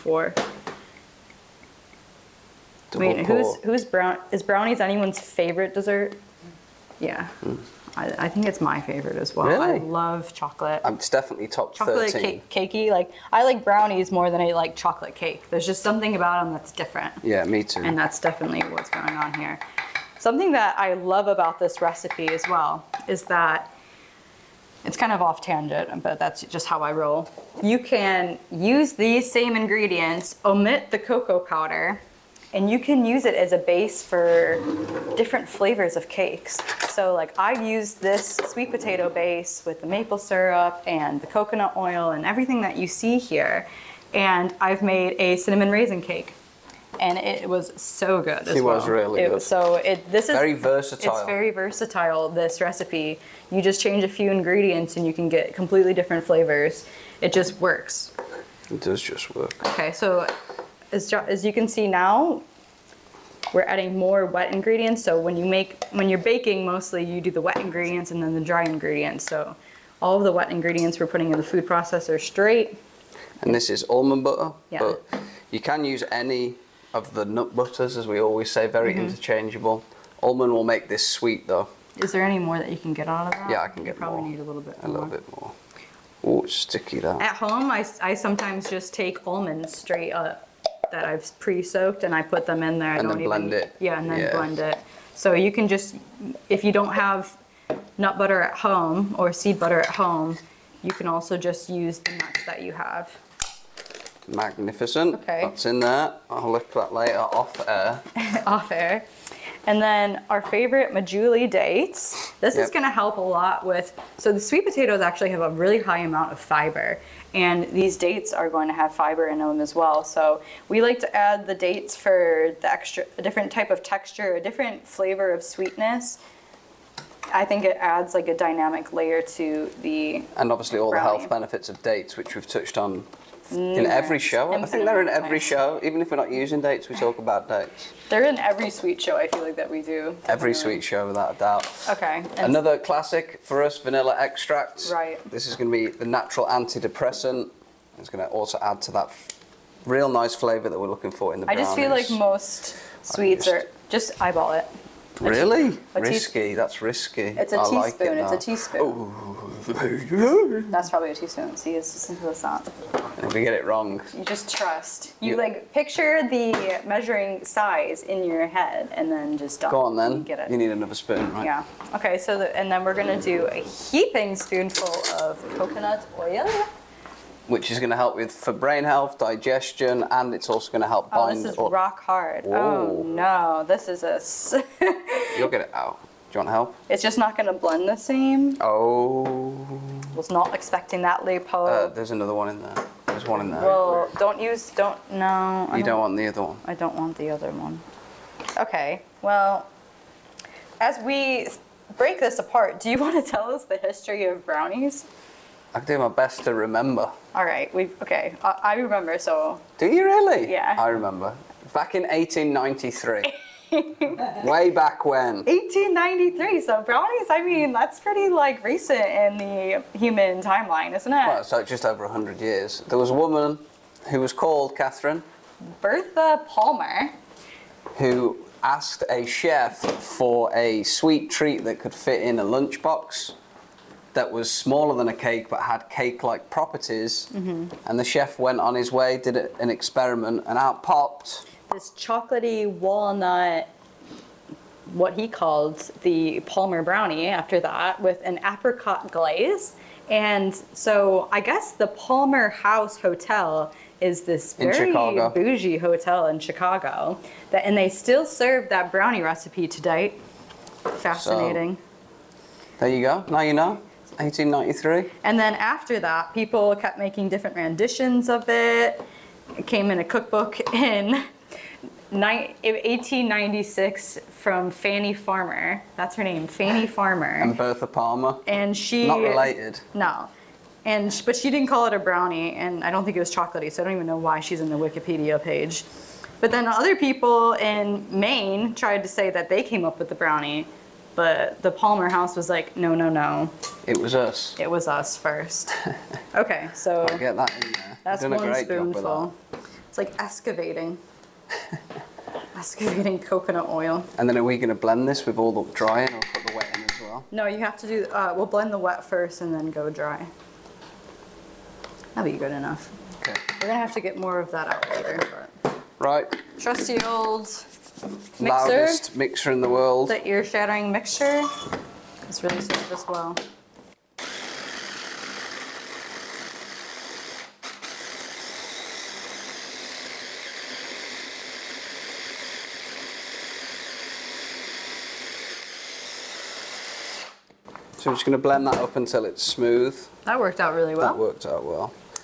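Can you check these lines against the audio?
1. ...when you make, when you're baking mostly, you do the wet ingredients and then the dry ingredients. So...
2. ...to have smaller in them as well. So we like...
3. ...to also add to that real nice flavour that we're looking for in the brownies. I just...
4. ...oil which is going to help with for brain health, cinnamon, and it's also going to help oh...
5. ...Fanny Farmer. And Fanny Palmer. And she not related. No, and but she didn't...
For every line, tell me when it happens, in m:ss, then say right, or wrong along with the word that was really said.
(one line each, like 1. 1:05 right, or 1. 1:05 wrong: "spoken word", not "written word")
1. 1:05 right
2. 1:58 wrong: "fiber", not "smaller"
3. 2:28 right
4. 2:56 wrong: "digestion", not "cinnamon"
5. 4:36 wrong: "Bertha", not "Fanny".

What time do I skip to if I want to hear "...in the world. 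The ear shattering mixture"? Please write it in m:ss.
5:19.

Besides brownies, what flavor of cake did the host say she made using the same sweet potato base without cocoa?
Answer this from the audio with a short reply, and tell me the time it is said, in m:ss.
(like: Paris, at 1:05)
cinnamon raisin, at 0:45.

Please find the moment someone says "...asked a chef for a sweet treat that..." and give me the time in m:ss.
3:48.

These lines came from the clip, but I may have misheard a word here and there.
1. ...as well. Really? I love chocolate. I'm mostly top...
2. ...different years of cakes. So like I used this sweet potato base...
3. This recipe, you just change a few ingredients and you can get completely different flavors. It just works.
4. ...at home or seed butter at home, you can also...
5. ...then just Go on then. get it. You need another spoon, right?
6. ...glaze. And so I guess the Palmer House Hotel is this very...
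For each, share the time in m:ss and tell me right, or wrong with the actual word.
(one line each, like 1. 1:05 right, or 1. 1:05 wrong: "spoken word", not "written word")
1. 0:09 wrong: "definitely", not "mostly"
2. 0:35 wrong: "flavors", not "years"
3. 0:52 right
4. 1:38 right
5. 2:49 right
6. 4:09 right.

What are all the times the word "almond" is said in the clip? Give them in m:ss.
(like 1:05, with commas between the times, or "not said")
1:13, 1:20, 1:29.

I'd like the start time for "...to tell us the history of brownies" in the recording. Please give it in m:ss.
3:23.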